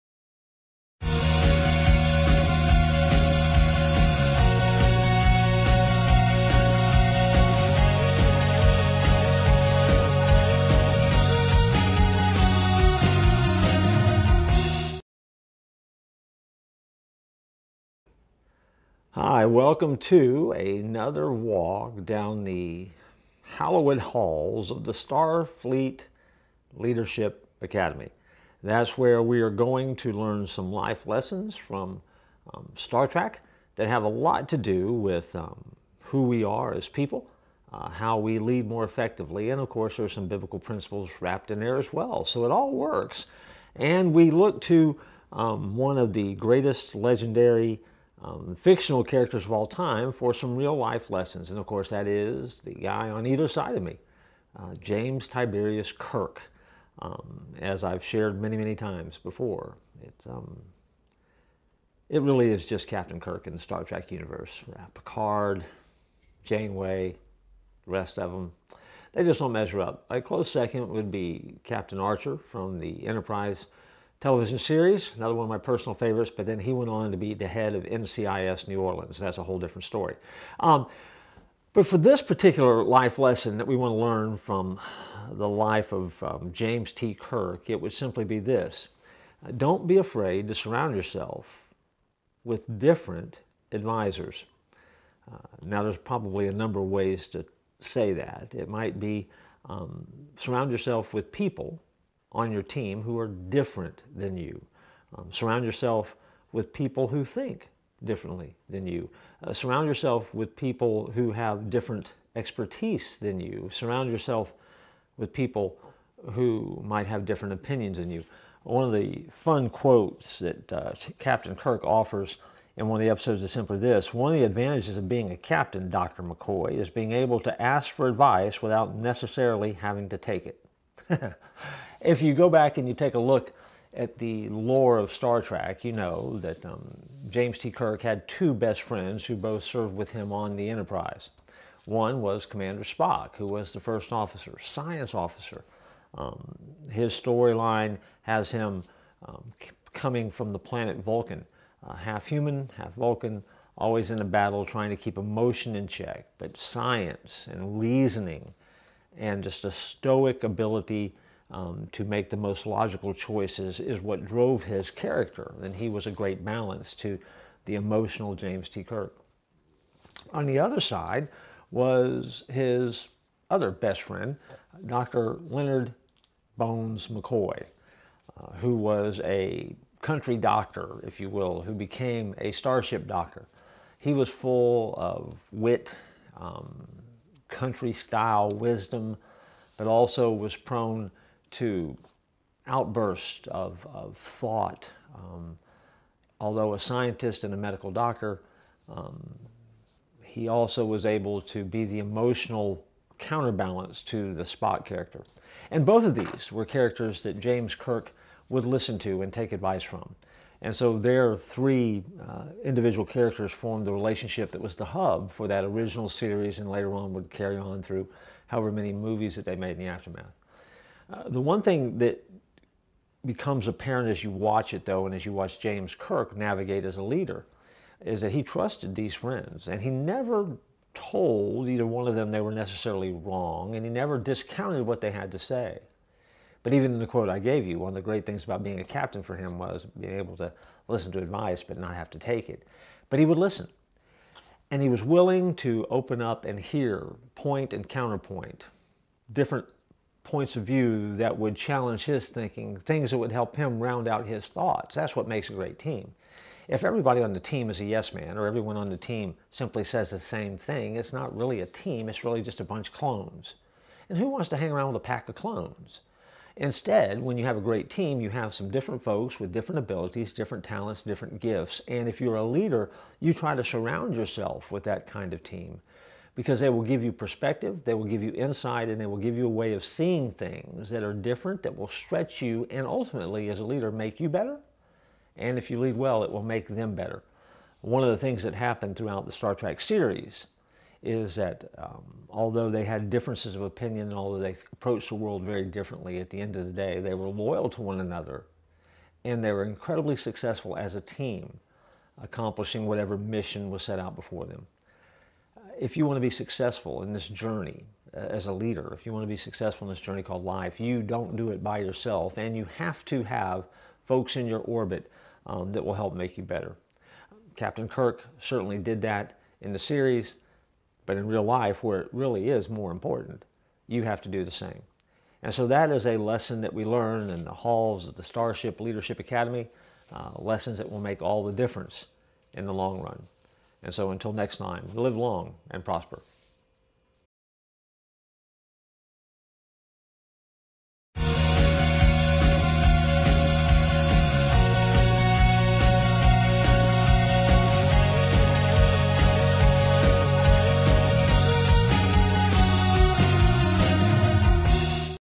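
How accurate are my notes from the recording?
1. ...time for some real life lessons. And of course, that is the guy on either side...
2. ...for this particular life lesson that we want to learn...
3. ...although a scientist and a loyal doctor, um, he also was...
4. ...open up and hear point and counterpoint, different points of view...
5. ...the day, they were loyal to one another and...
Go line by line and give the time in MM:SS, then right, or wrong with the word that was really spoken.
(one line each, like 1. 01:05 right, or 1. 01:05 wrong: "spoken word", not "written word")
1. 00:49 right
2. 01:21 right
3. 03:16 wrong: "medical", not "loyal"
4. 04:05 right
5. 04:56 right.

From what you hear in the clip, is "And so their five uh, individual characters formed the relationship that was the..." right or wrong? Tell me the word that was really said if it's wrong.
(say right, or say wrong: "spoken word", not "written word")
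wrong: "three", not "five".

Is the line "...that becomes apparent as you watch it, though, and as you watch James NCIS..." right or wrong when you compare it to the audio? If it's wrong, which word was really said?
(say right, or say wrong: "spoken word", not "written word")
wrong: "Kirk", not "NCIS".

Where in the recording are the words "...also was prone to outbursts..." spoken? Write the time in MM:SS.
03:09.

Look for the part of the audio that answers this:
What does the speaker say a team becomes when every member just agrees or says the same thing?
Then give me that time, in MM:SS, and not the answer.
04:22.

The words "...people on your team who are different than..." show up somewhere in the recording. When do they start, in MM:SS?
01:41.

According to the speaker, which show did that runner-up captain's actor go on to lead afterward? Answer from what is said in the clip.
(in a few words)
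NCIS New Orleans.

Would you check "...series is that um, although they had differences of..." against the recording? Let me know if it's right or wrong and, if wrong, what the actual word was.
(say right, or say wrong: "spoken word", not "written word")
right.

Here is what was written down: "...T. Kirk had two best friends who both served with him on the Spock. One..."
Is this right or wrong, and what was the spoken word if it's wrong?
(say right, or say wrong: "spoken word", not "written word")
wrong: "Enterprise", not "Spock".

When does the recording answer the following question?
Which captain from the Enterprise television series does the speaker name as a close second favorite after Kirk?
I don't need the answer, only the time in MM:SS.
01:11.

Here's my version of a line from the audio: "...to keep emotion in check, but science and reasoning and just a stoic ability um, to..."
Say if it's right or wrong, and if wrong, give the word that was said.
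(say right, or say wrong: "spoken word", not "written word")
right.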